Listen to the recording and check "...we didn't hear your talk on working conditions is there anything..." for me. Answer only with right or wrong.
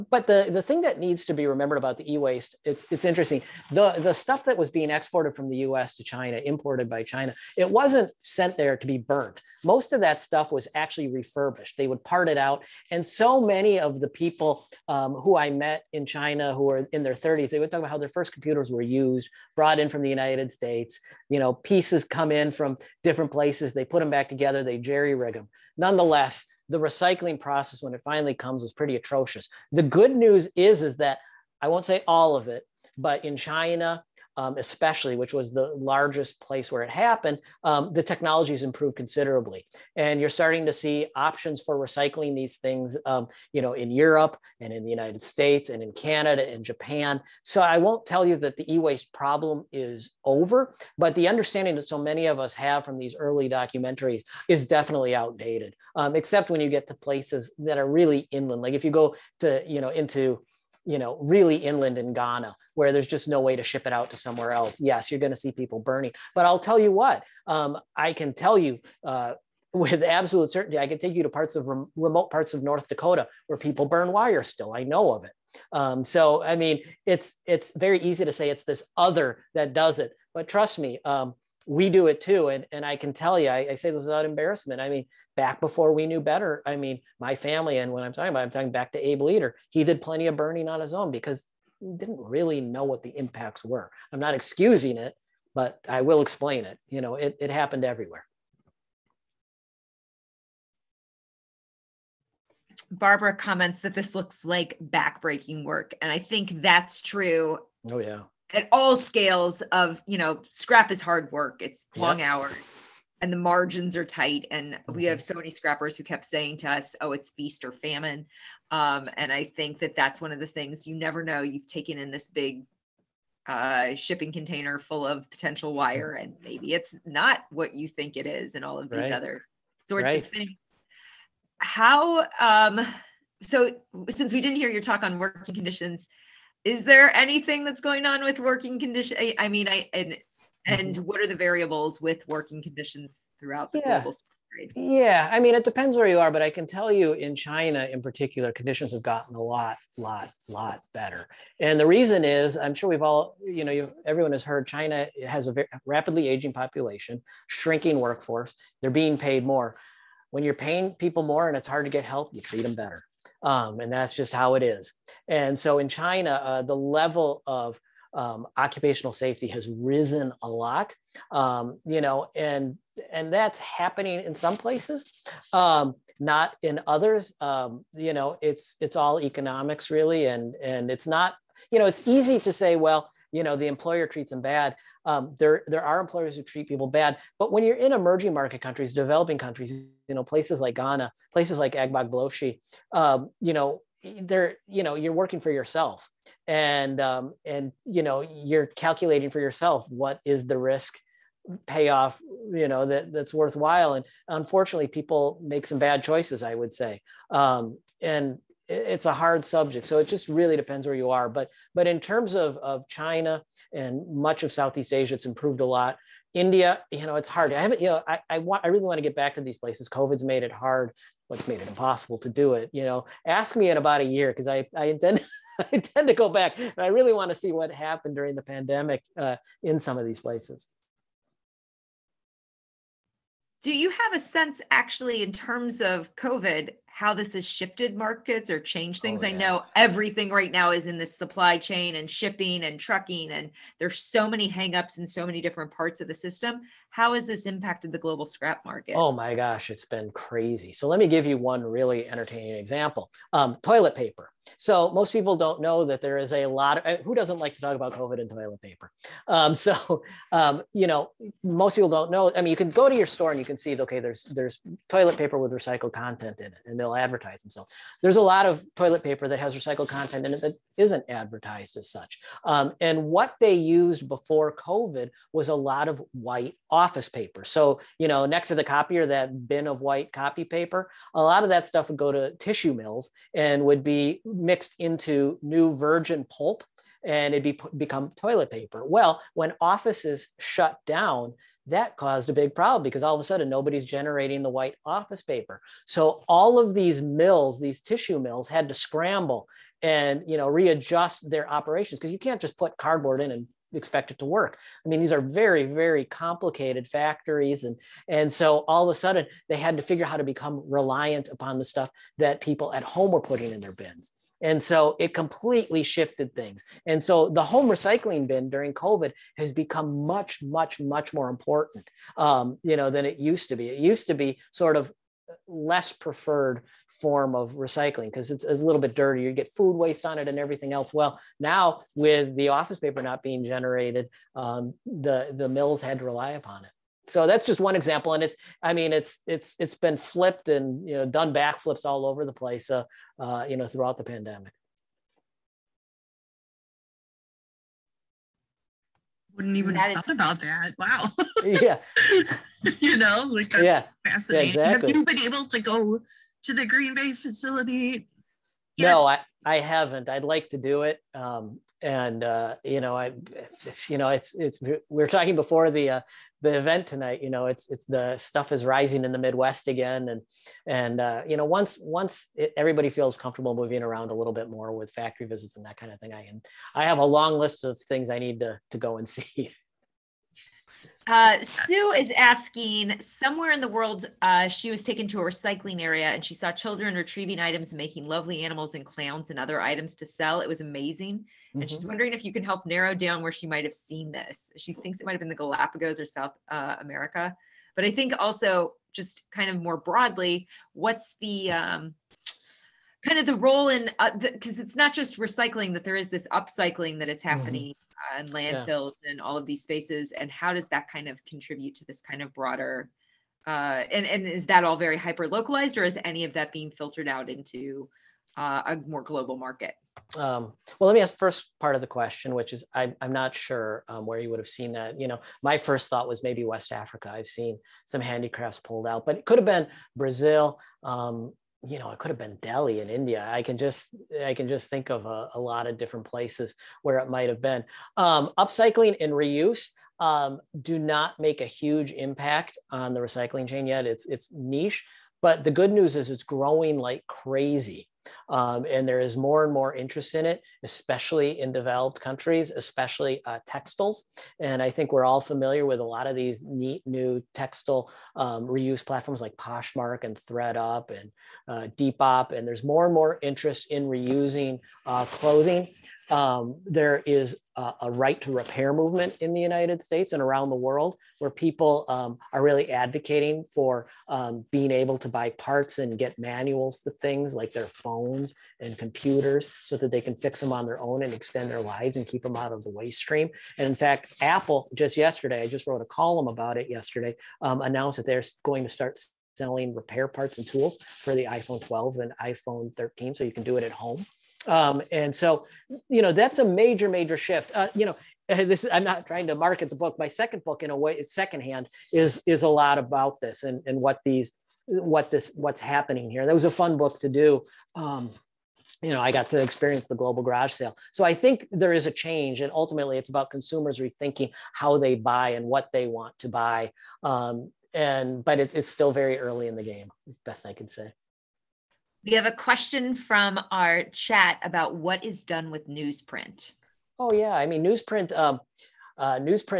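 right.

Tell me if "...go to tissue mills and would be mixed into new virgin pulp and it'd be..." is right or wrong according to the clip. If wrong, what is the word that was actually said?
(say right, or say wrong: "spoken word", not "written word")
right.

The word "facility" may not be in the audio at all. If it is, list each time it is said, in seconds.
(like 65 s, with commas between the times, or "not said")
357 s.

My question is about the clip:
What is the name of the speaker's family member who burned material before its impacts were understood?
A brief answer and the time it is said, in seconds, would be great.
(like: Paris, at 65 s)
Abe Leader, at 89 s.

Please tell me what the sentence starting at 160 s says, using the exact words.
When you're paying people more and it's hard to get help, you treat them better.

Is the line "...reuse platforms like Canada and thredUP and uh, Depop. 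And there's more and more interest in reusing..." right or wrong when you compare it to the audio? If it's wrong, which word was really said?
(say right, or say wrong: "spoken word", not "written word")
wrong: "Poshmark", not "Canada".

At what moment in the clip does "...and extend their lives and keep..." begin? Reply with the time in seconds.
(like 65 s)
481 s.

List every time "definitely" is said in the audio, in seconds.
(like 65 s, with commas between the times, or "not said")
54 s.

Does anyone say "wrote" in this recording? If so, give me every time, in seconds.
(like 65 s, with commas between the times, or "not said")
485 s.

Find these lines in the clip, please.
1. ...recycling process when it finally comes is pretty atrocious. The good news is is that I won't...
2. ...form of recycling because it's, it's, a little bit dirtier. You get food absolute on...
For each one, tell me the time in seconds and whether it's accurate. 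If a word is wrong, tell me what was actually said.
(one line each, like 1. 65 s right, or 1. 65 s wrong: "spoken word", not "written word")
1. 26 s right
2. 326 s wrong: "waste", not "absolute".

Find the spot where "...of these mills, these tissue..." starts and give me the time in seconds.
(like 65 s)
296 s.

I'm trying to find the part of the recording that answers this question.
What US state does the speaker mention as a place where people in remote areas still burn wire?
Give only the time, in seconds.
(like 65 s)
72 s.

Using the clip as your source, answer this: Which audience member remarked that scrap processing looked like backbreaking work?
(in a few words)
Barbara.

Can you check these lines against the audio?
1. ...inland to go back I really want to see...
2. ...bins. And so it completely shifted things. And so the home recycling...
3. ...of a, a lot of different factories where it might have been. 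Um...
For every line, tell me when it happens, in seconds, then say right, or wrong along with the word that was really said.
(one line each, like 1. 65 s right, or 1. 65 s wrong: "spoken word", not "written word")
1. 225 s wrong: "intend", not "inland"
2. 313 s right
3. 434 s wrong: "places", not "factories".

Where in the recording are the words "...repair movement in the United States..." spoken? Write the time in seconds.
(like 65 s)
468 s.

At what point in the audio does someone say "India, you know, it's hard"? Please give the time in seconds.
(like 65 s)
216 s.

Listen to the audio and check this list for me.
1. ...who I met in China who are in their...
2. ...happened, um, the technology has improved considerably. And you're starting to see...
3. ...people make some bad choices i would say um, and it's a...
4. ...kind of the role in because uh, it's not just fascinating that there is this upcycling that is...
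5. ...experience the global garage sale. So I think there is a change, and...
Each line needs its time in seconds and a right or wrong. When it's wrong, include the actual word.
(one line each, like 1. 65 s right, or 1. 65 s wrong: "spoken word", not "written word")
1. 15 s right
2. 36 s right
3. 204 s right
4. 403 s wrong: "recycling", not "fascinating"
5. 509 s right.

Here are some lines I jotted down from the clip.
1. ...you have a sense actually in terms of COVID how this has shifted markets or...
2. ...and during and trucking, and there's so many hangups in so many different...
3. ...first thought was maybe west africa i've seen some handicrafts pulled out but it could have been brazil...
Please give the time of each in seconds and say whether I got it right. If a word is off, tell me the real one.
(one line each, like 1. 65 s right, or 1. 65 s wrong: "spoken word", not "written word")
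1. 233 s right
2. 241 s wrong: "shipping", not "during"
3. 425 s right.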